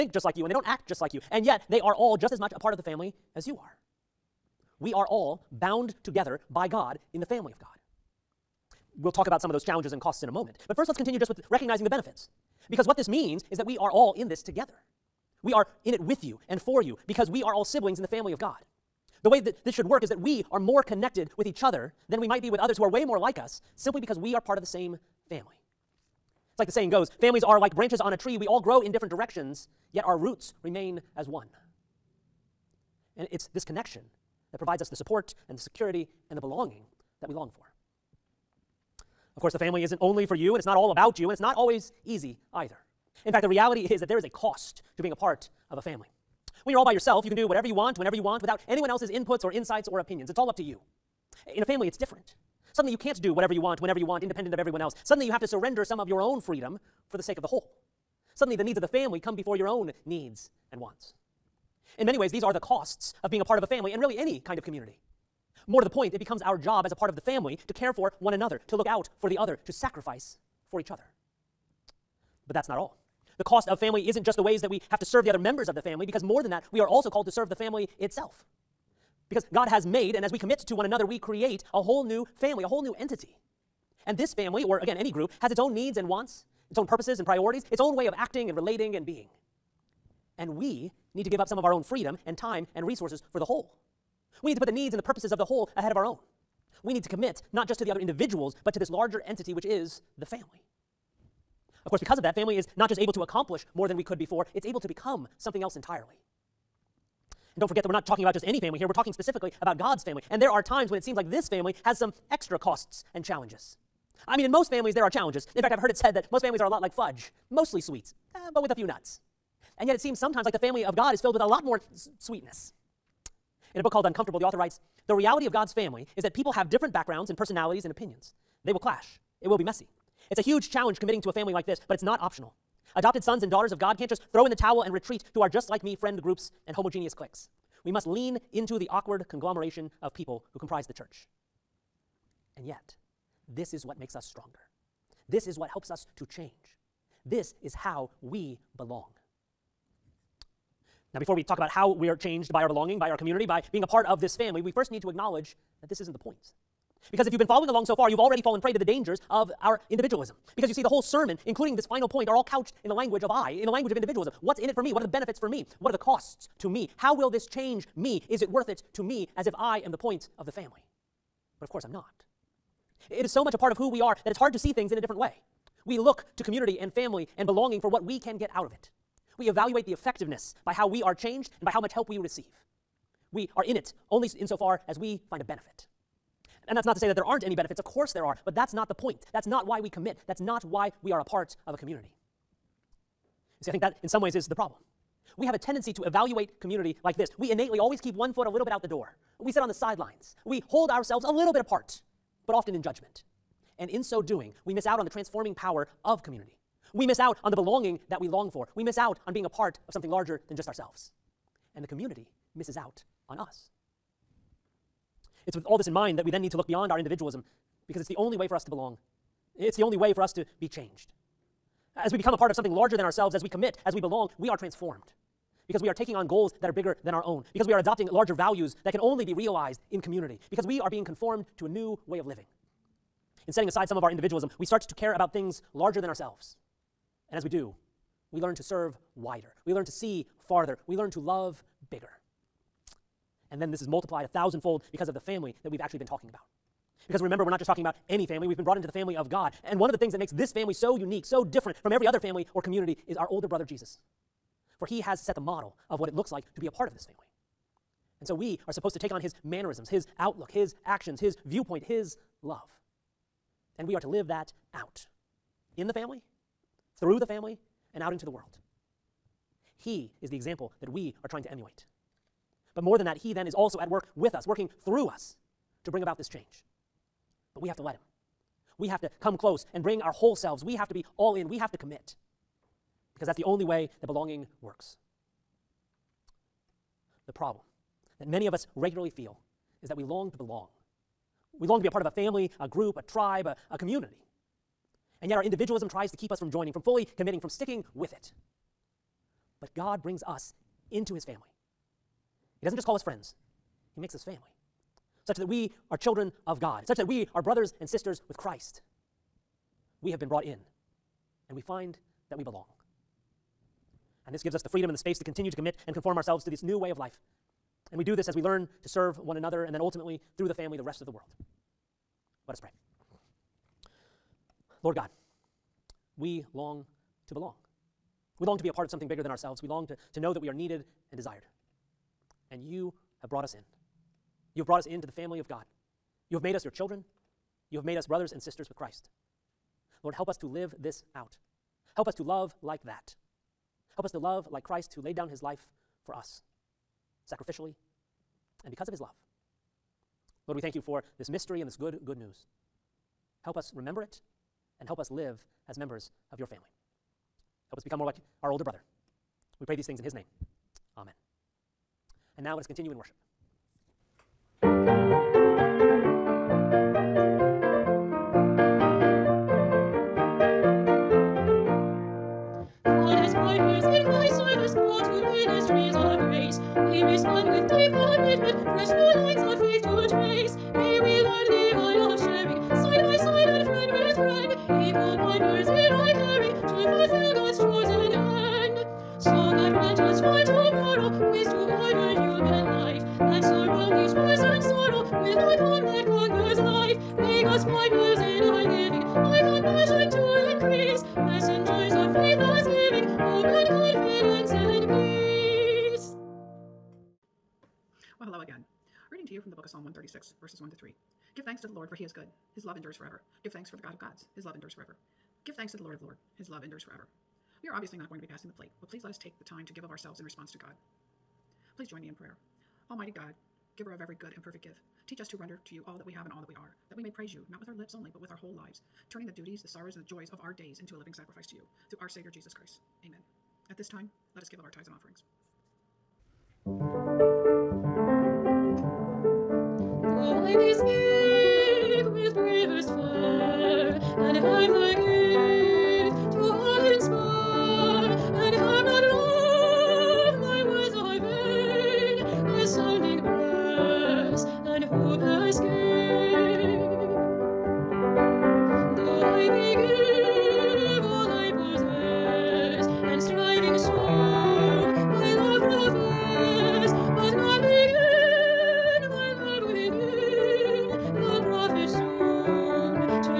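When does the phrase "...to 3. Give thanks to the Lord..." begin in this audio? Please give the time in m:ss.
6:50.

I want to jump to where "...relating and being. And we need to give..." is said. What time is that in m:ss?
1:28.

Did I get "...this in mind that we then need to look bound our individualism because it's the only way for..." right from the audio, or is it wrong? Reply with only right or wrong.
wrong.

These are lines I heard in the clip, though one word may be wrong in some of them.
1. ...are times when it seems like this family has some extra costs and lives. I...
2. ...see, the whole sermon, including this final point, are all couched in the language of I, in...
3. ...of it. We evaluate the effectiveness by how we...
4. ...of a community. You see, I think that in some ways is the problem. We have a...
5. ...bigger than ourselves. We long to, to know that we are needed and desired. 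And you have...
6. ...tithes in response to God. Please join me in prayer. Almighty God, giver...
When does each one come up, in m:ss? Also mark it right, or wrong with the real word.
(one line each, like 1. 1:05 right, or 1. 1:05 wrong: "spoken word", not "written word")
1. 1:50 wrong: "challenges", not "lives"
2. 2:40 right
3. 2:58 right
4. 3:11 right
5. 5:29 right
6. 6:59 wrong: "ourselves", not "tithes".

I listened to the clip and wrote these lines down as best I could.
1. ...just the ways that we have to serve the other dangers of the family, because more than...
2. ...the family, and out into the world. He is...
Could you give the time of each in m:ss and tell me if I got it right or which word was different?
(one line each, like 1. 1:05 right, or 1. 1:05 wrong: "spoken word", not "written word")
1. 1:14 wrong: "members", not "dangers"
2. 4:27 right.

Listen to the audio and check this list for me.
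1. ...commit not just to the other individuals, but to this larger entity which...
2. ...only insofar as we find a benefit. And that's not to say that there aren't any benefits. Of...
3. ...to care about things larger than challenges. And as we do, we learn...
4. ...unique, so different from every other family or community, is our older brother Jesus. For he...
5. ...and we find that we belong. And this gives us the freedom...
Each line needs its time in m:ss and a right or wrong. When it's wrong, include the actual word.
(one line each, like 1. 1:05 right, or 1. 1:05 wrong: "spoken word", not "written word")
1. 1:37 right
2. 3:04 right
3. 3:54 wrong: "ourselves", not "challenges"
4. 4:10 right
5. 5:11 right.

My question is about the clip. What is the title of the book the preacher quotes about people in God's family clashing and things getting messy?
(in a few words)
Uncomfortable.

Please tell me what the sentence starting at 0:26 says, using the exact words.
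It's like the saying goes families are like branches on a tree.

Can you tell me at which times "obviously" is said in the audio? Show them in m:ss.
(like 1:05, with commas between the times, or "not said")
6:57.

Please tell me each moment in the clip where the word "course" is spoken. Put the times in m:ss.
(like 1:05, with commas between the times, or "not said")
0:39, 1:41, 2:51, 3:07.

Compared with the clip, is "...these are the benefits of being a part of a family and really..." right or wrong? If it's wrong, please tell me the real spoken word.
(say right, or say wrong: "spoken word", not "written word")
wrong: "costs", not "benefits".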